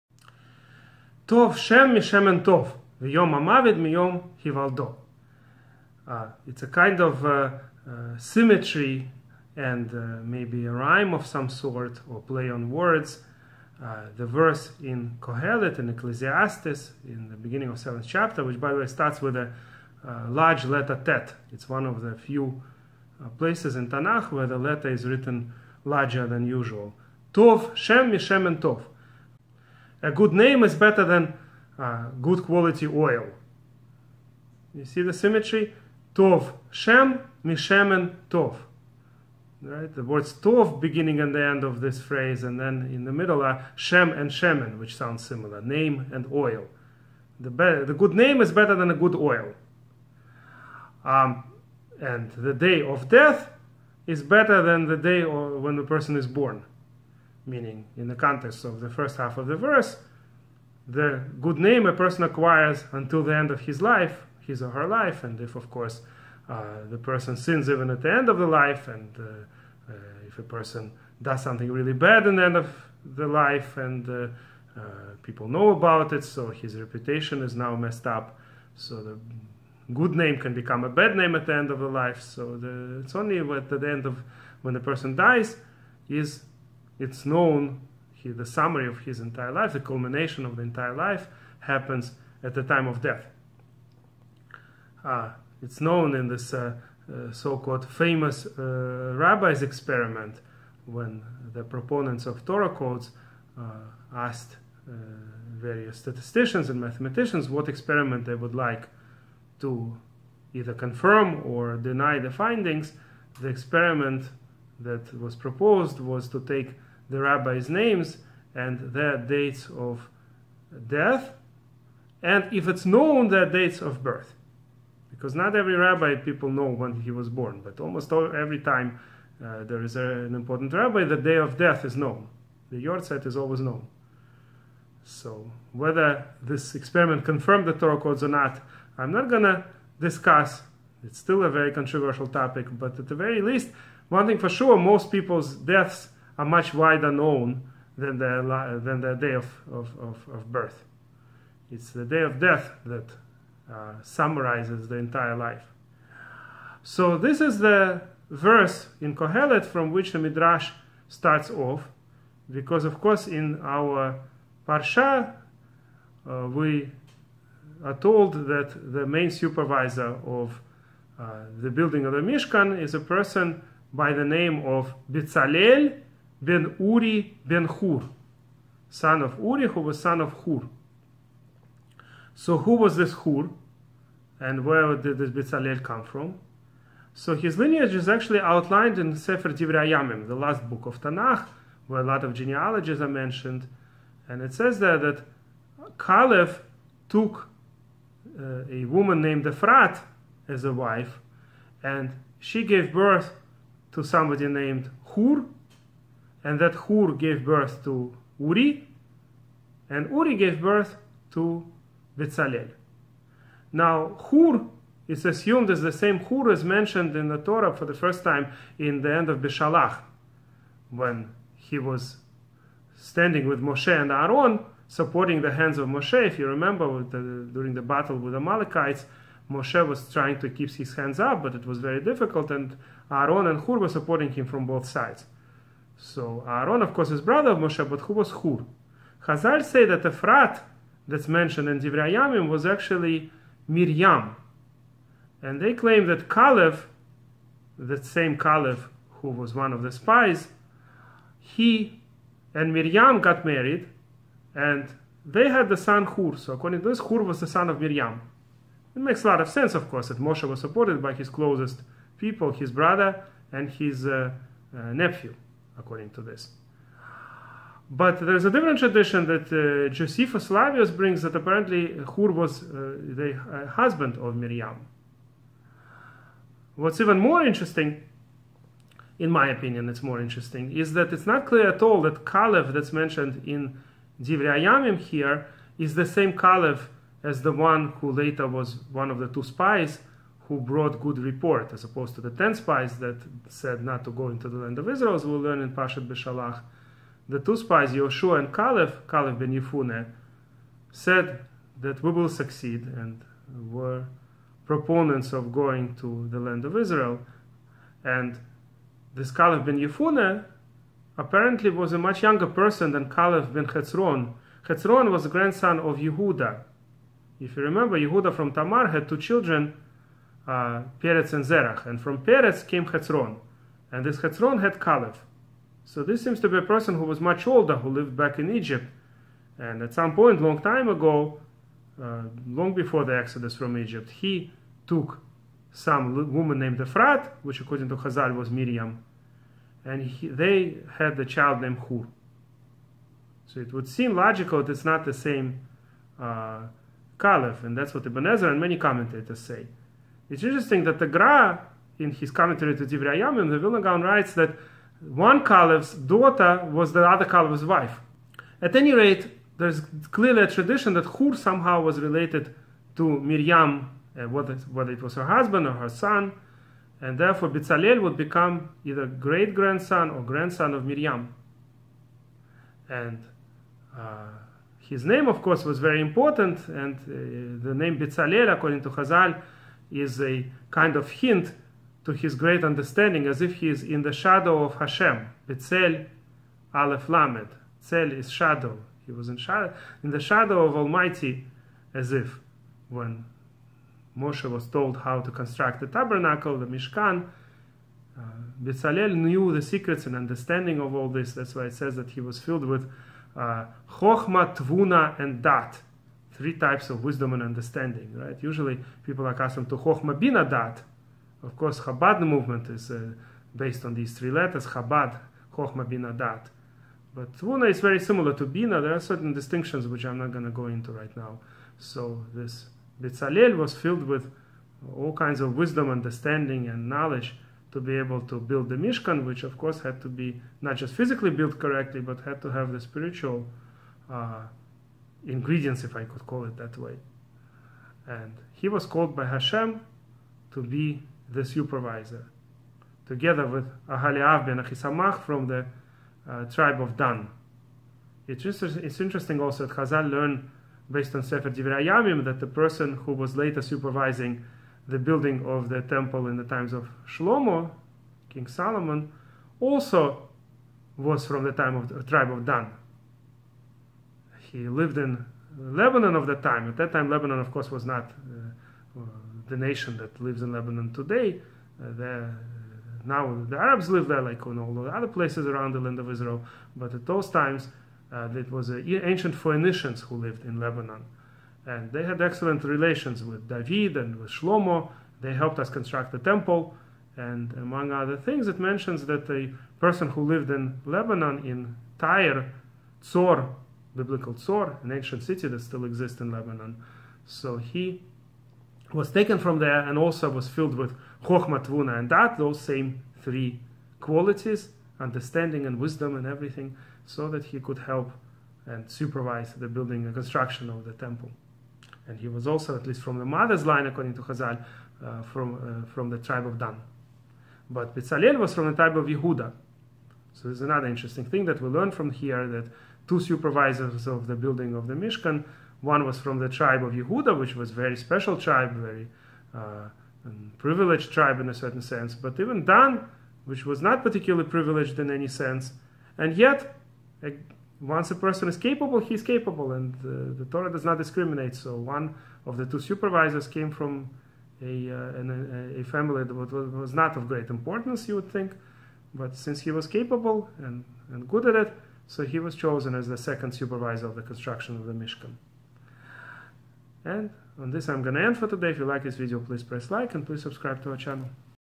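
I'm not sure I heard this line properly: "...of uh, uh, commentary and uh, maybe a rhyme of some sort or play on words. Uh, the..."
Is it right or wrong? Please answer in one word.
wrong.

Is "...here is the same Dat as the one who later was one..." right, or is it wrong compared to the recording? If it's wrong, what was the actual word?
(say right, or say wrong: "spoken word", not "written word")
wrong: "Calev", not "Dat".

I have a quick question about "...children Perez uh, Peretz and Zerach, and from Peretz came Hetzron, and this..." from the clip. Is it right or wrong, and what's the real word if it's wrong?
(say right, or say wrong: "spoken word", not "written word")
right.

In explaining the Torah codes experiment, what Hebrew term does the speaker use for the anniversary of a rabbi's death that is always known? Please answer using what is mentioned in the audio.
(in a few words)
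yortzeit.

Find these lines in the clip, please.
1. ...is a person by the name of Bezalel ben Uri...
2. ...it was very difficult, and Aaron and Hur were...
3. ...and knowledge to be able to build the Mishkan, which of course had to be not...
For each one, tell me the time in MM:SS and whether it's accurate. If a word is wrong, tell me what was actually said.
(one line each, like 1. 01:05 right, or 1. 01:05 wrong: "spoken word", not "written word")
1. 02:52 right
2. 03:51 right
3. 07:06 right.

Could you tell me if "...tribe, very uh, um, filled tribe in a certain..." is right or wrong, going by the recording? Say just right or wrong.
wrong.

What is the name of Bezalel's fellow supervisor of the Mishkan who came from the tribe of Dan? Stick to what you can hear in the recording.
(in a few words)
Ahaliav ben Achisamach.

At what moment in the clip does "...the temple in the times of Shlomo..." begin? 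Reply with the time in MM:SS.
07:35.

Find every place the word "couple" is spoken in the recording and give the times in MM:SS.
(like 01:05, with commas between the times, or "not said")
not said.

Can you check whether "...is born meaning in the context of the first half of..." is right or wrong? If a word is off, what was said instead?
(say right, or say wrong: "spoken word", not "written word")
right.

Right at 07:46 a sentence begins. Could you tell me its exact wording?
At that time, Lebanon, of course, was not uh, uh the nation that lives in Lebanon today.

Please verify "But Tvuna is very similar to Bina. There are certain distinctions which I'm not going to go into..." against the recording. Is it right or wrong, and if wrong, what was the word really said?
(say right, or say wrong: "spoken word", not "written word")
right.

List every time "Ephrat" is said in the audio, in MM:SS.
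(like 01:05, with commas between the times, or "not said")
03:19, 04:00, 05:36.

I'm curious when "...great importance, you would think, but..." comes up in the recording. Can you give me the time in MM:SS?
09:07.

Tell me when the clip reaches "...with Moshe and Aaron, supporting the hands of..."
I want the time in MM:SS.
03:43.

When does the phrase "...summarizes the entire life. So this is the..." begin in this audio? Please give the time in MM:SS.
02:34.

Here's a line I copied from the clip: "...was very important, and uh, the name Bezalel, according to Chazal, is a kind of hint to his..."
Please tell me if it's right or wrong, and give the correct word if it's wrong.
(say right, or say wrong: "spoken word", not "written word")
right.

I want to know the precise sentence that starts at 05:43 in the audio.
So it would seem logical that it's not the same uh, Calev, and that's what Ibn Ezra and many commentators say.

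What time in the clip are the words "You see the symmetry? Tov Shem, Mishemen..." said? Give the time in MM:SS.
00:34.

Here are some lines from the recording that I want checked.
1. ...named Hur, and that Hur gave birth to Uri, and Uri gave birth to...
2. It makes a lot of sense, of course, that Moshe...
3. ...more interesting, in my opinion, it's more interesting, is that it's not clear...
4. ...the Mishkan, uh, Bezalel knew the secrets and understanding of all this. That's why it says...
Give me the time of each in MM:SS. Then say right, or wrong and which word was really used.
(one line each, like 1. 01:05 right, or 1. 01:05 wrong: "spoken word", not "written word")
1. 03:24 right
2. 04:18 right
3. 04:37 right
4. 06:36 right.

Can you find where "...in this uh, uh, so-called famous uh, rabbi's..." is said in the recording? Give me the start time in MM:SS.
01:36.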